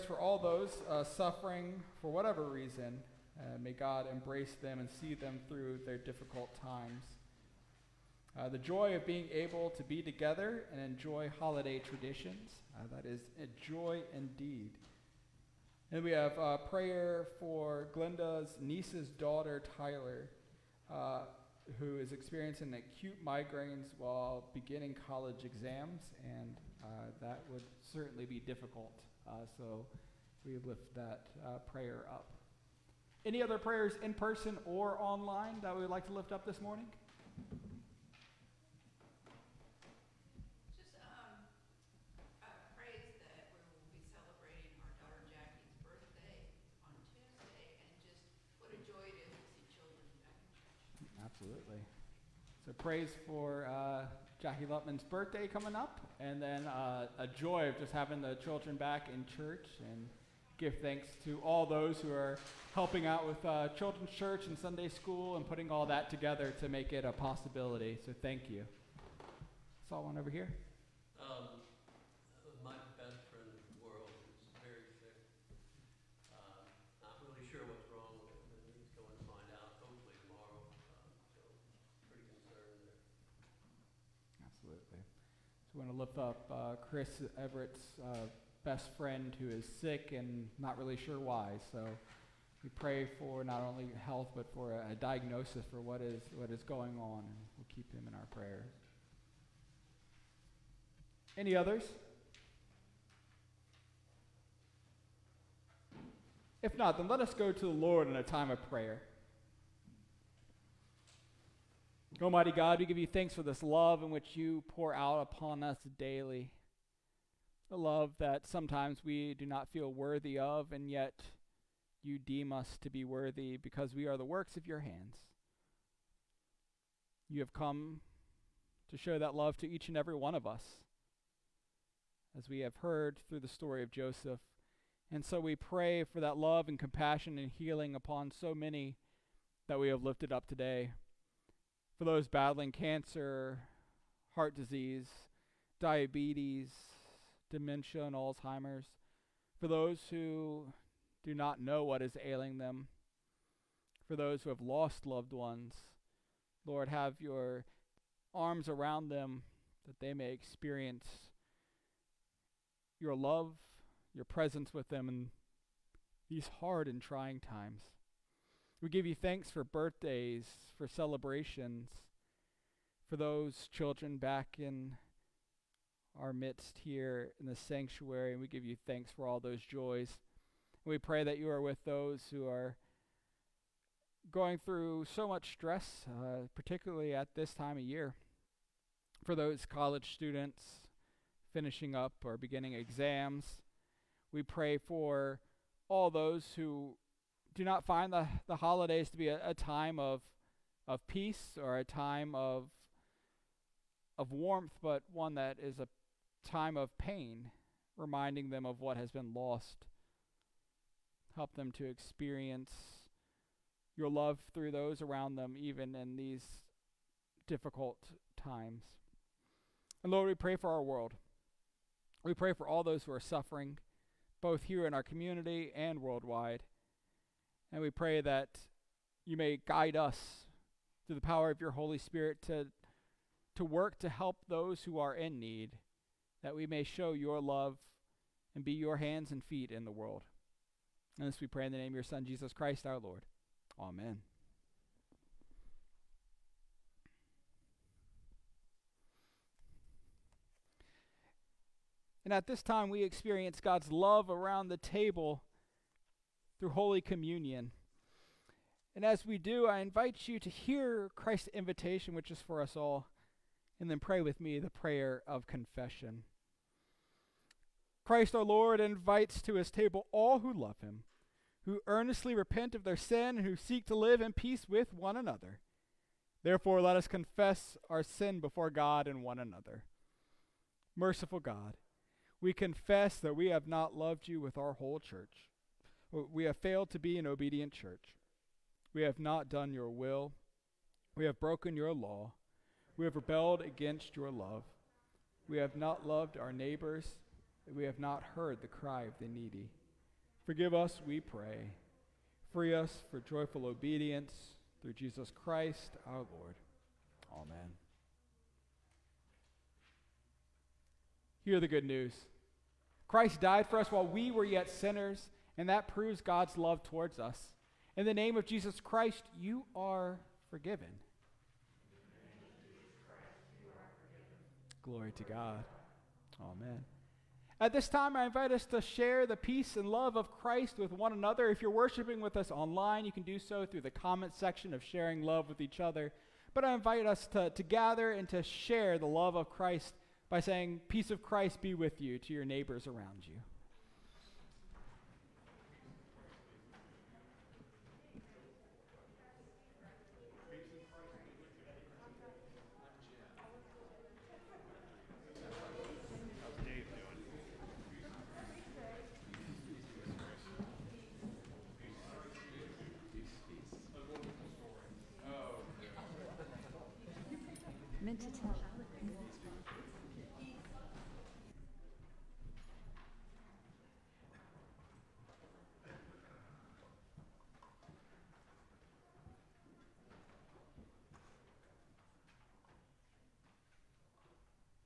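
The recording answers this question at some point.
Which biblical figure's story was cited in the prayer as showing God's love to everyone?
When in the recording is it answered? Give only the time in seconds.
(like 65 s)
133 s.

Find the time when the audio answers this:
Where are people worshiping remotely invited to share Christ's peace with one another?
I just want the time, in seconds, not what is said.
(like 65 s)
333 s.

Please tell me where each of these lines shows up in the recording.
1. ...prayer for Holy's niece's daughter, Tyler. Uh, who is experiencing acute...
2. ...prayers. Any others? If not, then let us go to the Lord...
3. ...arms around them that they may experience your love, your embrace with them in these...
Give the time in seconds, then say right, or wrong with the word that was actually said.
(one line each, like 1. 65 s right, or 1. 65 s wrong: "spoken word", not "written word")
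1. 16 s wrong: "Glenda", not "Holy"
2. 98 s right
3. 158 s wrong: "presence", not "embrace".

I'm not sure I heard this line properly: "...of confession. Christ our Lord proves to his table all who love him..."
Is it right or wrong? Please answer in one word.
wrong.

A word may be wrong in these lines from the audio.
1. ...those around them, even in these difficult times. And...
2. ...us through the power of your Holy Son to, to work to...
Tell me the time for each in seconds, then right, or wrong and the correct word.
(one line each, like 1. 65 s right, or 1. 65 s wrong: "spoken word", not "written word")
1. 214 s right
2. 229 s wrong: "Spirit", not "Son".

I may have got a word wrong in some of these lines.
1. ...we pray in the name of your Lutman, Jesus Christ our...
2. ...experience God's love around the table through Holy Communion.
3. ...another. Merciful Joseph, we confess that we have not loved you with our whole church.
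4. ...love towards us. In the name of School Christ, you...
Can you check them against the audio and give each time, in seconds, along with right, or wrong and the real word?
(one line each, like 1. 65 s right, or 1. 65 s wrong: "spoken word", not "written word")
1. 241 s wrong: "Son", not "Lutman"
2. 253 s right
3. 279 s wrong: "God", not "Joseph"
4. 316 s wrong: "Jesus", not "School".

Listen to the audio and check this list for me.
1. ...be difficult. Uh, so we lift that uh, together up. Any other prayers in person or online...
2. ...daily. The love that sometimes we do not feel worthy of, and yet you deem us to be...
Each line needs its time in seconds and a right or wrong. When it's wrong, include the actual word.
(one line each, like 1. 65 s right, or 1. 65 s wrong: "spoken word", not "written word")
1. 28 s wrong: "prayer", not "together"
2. 115 s right.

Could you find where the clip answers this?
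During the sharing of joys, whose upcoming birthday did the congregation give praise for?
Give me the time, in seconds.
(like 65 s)
54 s.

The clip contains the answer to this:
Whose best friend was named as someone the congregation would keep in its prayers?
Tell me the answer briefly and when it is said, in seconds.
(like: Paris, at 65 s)
Chris Everett, at 86 s.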